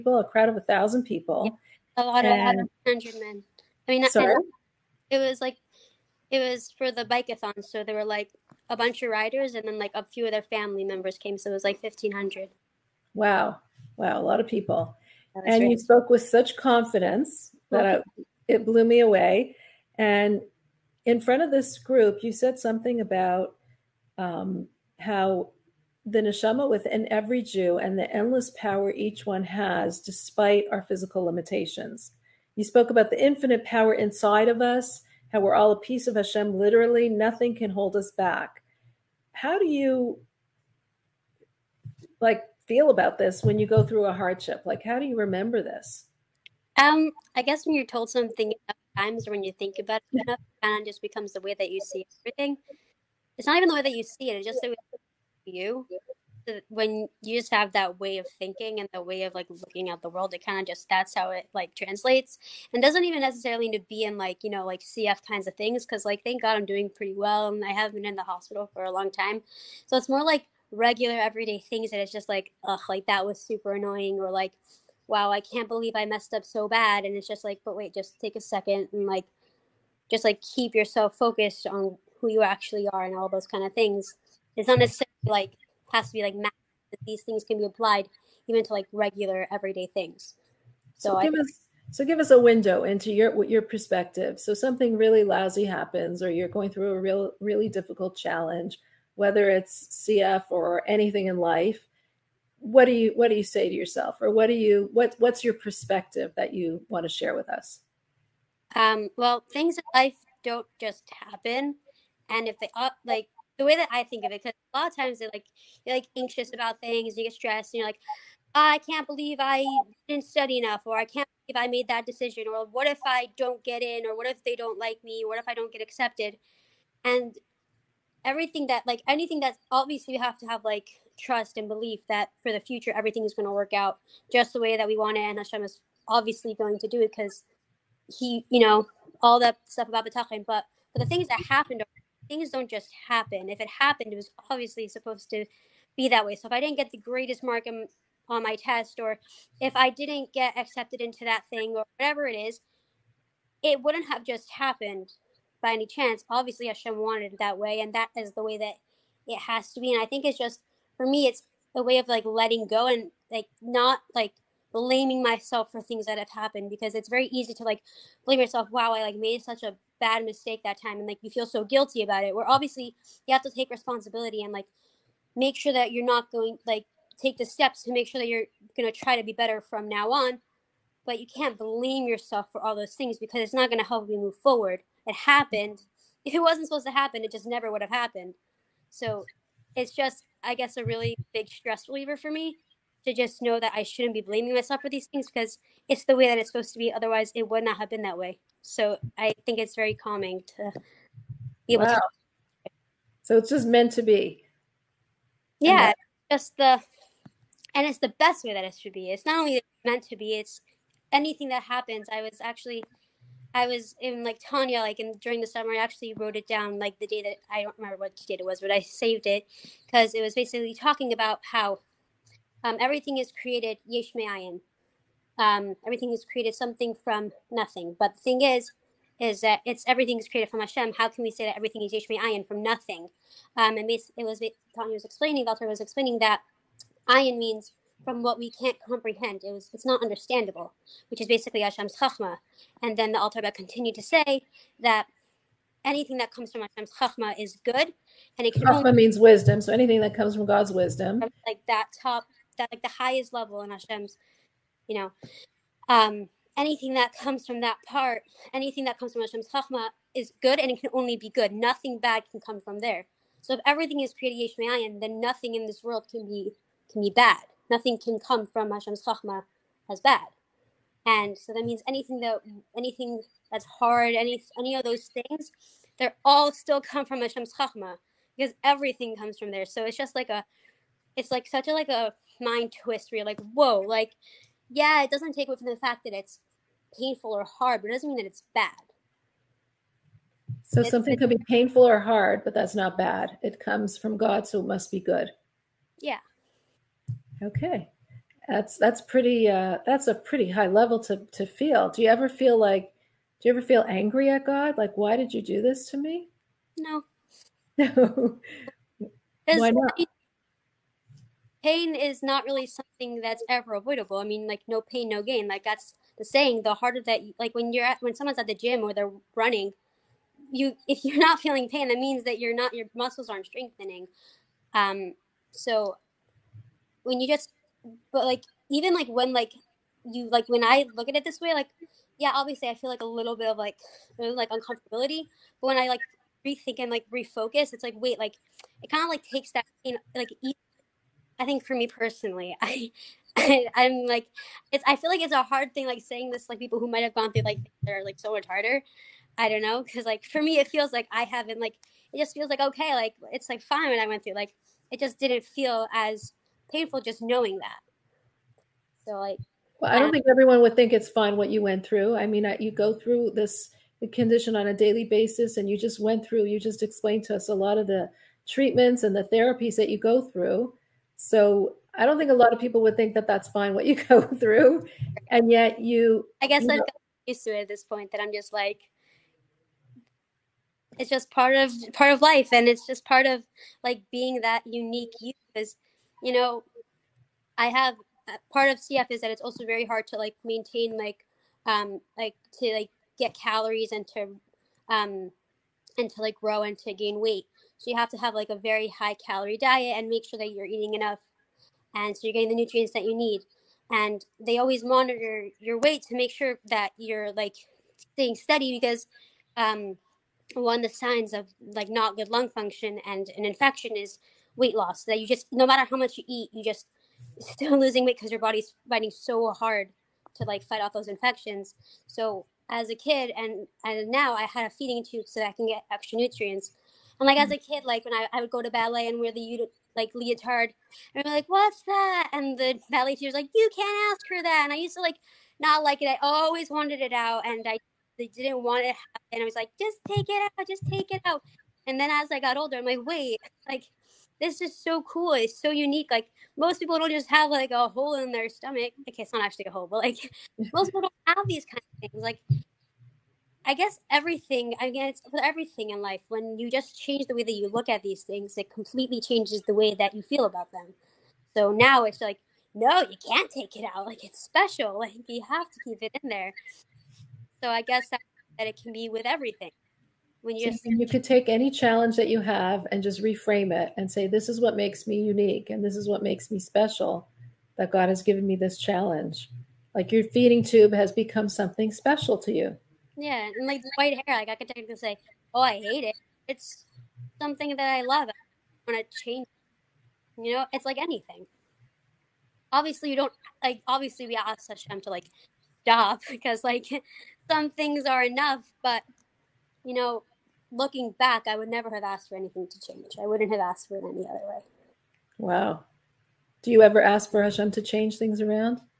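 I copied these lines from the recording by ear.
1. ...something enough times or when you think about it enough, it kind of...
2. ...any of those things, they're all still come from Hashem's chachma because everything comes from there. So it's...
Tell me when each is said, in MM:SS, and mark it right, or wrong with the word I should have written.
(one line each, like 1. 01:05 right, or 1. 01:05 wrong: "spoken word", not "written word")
1. 00:48 right
2. 04:34 right.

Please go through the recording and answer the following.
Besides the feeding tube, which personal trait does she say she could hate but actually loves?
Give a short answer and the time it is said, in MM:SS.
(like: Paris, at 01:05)
white hair, at 08:03.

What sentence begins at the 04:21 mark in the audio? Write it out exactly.
Nothing bad can come from there.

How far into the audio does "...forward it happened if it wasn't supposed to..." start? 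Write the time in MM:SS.
03:04.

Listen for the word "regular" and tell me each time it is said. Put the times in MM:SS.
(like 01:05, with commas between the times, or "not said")
01:10, 01:28.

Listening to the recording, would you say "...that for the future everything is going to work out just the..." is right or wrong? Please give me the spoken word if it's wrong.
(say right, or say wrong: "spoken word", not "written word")
right.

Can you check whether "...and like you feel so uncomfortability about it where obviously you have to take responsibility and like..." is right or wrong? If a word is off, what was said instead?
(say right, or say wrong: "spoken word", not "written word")
wrong: "guilty", not "uncomfortability".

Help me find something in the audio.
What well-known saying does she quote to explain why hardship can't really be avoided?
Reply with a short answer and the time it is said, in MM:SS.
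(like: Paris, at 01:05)
no pain, no gain, at 05:14.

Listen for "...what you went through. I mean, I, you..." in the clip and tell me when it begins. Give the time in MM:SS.
06:01.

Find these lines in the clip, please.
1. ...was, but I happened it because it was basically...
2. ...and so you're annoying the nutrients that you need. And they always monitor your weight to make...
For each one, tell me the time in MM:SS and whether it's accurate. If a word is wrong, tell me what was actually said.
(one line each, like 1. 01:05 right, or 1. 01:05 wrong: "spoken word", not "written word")
1. 03:38 wrong: "saved", not "happened"
2. 06:41 wrong: "getting", not "annoying".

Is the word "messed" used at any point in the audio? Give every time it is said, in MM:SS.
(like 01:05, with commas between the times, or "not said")
01:16.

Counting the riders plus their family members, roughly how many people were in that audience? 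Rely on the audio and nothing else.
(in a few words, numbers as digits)
1500.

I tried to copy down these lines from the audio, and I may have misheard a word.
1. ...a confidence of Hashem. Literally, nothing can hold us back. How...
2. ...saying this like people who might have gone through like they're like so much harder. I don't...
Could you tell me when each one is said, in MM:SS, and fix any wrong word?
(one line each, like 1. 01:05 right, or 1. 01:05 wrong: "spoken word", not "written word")
1. 00:35 wrong: "piece", not "confidence"
2. 05:46 right.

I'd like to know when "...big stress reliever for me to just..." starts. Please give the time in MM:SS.
03:11.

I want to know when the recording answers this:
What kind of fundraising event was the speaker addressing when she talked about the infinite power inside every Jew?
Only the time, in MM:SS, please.
00:07.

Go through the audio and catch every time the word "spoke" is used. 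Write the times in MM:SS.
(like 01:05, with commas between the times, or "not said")
00:15, 00:32.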